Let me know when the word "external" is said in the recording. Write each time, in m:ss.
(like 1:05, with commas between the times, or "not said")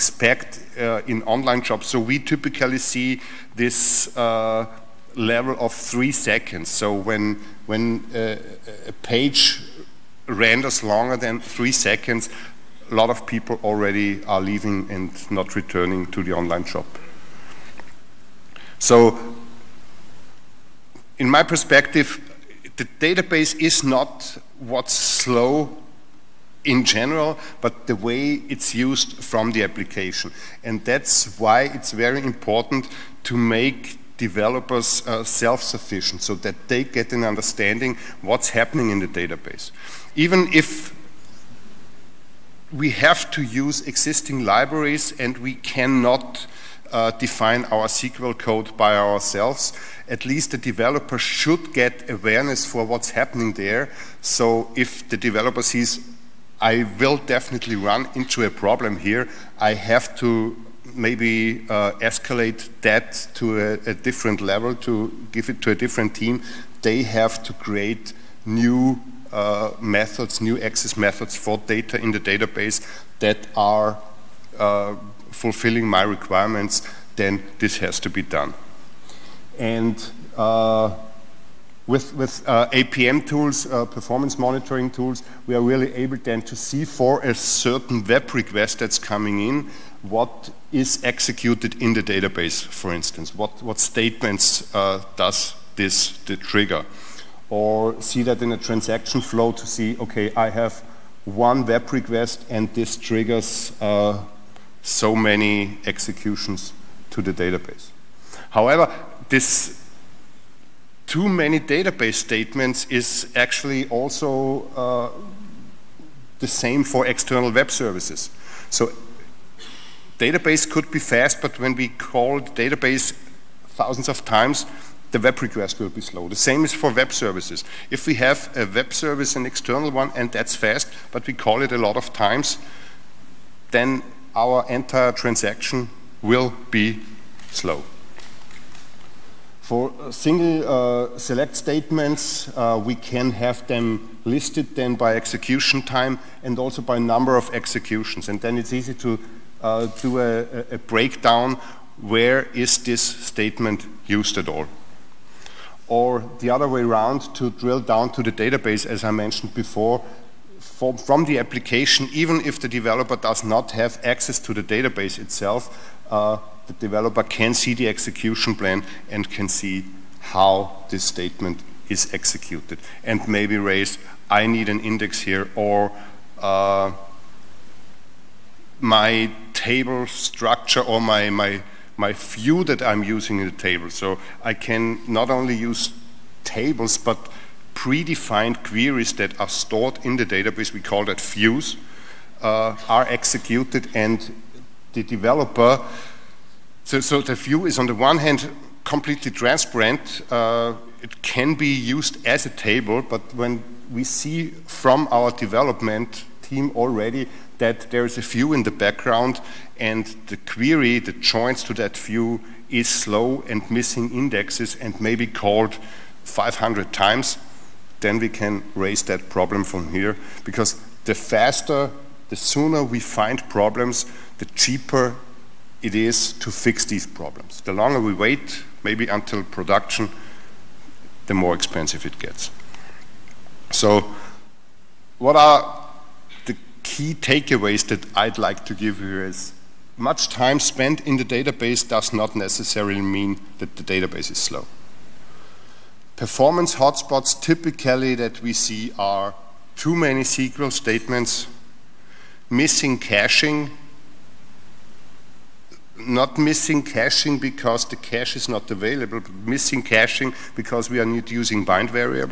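1:57, 2:09.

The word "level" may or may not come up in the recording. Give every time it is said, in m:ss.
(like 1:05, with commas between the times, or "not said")
0:05, 1:04.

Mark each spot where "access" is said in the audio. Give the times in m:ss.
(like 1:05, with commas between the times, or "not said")
1:10, 2:44.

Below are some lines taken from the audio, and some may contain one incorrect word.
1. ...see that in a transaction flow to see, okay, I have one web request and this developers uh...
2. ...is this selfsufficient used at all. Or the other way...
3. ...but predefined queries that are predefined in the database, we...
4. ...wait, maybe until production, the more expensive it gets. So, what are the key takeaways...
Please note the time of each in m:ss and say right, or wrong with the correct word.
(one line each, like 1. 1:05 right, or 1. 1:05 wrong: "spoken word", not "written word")
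1. 1:37 wrong: "triggers", not "developers"
2. 2:32 wrong: "statement", not "selfsufficient"
3. 3:06 wrong: "stored", not "predefined"
4. 3:48 right.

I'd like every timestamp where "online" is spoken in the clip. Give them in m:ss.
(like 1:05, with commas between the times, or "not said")
0:01, 0:16.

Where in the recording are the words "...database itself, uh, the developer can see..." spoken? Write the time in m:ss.
2:44.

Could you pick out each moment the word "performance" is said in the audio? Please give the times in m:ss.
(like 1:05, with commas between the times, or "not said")
1:23, 4:06.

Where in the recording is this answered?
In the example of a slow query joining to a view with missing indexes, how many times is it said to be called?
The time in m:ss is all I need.
3:36.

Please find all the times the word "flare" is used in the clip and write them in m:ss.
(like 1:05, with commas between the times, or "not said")
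not said.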